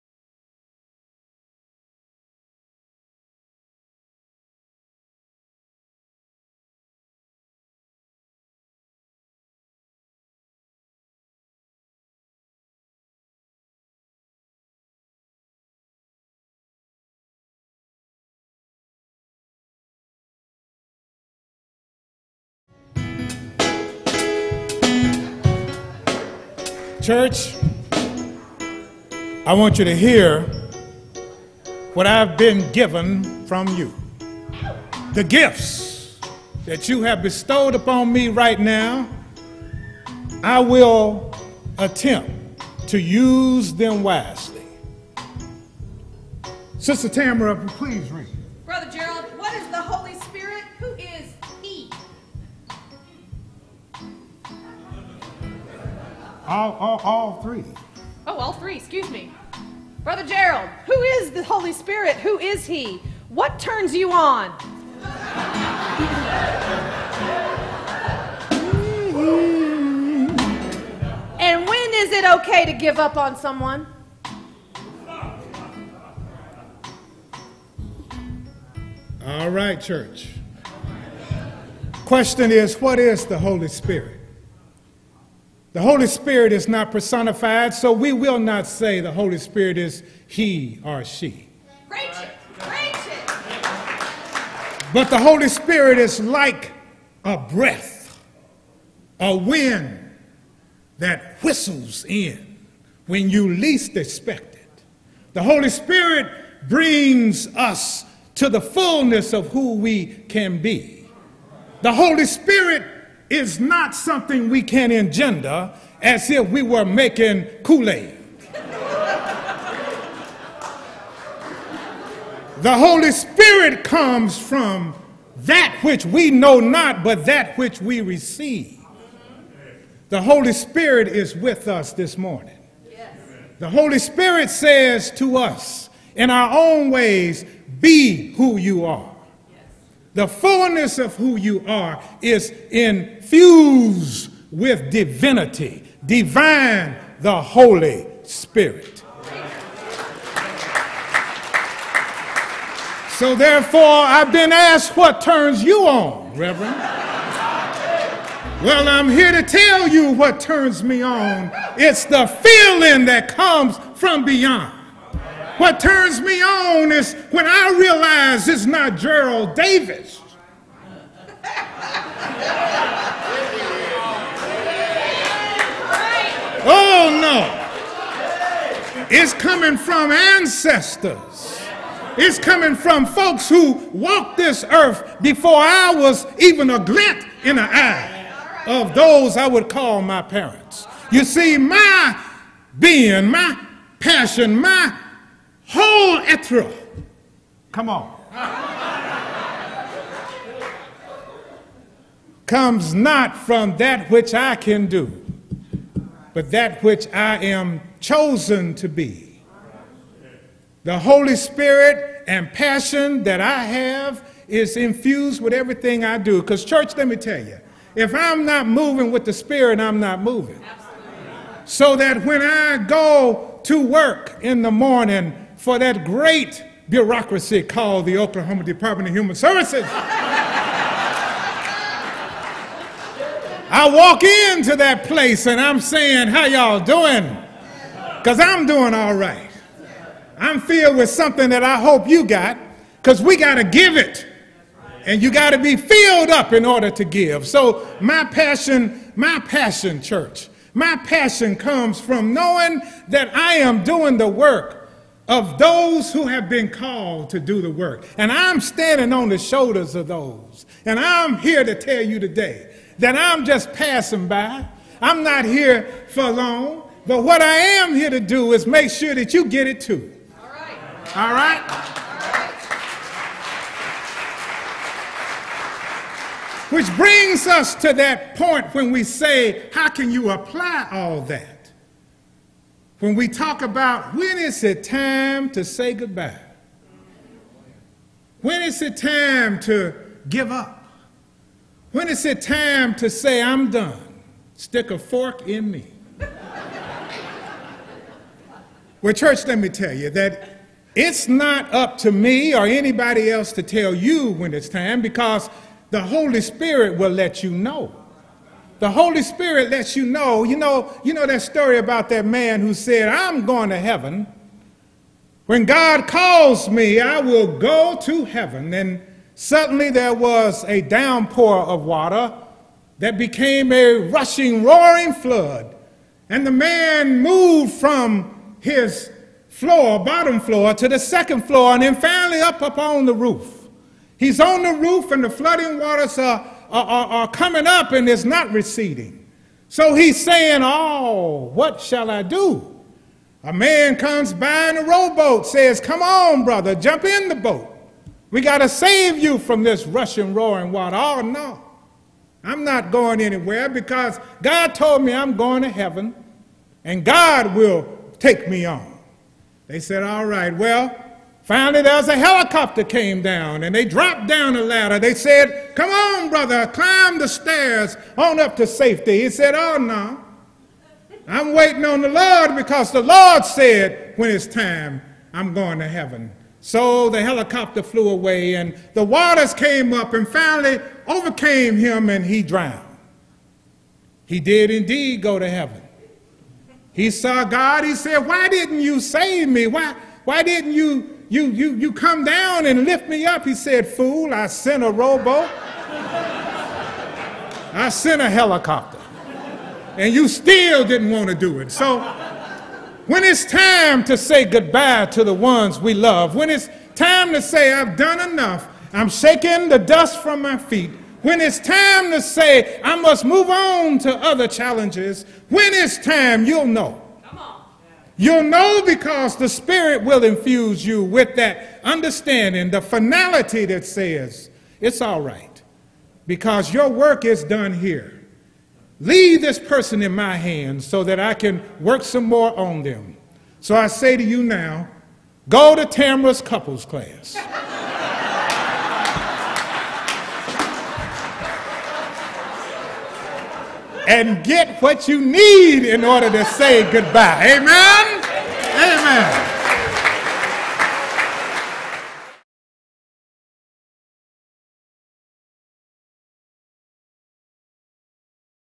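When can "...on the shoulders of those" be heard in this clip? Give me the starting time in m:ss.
4:19.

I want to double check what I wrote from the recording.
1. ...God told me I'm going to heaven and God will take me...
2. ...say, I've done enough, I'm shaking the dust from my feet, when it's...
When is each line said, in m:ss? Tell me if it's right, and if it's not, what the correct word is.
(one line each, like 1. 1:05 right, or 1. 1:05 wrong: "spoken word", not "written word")
1. 5:54 right
2. 6:47 right.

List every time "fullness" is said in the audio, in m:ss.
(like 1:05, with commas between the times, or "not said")
1:48, 2:20.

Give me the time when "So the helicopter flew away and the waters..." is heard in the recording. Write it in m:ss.
6:16.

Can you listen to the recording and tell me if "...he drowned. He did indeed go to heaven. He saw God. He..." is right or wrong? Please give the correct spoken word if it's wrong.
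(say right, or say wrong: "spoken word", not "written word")
right.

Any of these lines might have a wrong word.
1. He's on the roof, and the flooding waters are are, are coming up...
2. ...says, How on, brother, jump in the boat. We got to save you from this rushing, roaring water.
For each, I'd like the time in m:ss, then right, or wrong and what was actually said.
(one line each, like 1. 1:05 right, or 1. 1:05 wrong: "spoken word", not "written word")
1. 5:34 right
2. 5:45 wrong: "Come", not "How".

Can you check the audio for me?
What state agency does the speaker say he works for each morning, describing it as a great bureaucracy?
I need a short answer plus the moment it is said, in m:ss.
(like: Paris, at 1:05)
Oklahoma Department of Human Services, at 3:48.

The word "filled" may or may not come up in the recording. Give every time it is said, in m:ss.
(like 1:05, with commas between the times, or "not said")
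4:00, 4:05.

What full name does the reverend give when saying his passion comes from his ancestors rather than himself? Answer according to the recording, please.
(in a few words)
Gerald Davis.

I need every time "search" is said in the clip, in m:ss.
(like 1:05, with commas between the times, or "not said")
not said.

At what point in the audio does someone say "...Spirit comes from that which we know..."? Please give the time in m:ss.
2:03.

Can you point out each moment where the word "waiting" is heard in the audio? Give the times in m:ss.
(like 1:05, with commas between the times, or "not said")
6:11.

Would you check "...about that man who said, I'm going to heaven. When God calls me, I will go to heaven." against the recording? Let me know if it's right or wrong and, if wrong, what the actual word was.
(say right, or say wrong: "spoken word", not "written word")
right.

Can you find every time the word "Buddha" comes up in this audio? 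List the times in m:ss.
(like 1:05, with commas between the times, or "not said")
not said.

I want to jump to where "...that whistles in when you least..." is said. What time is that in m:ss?
1:40.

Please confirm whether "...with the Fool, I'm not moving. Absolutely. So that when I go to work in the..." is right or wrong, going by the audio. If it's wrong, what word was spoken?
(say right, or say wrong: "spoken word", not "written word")
wrong: "Spirit", not "Fool".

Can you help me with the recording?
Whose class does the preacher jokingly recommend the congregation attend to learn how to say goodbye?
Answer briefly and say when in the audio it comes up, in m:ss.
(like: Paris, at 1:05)
Tamra's couples class, at 7:15.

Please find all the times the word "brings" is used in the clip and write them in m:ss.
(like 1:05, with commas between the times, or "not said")
1:46, 4:36.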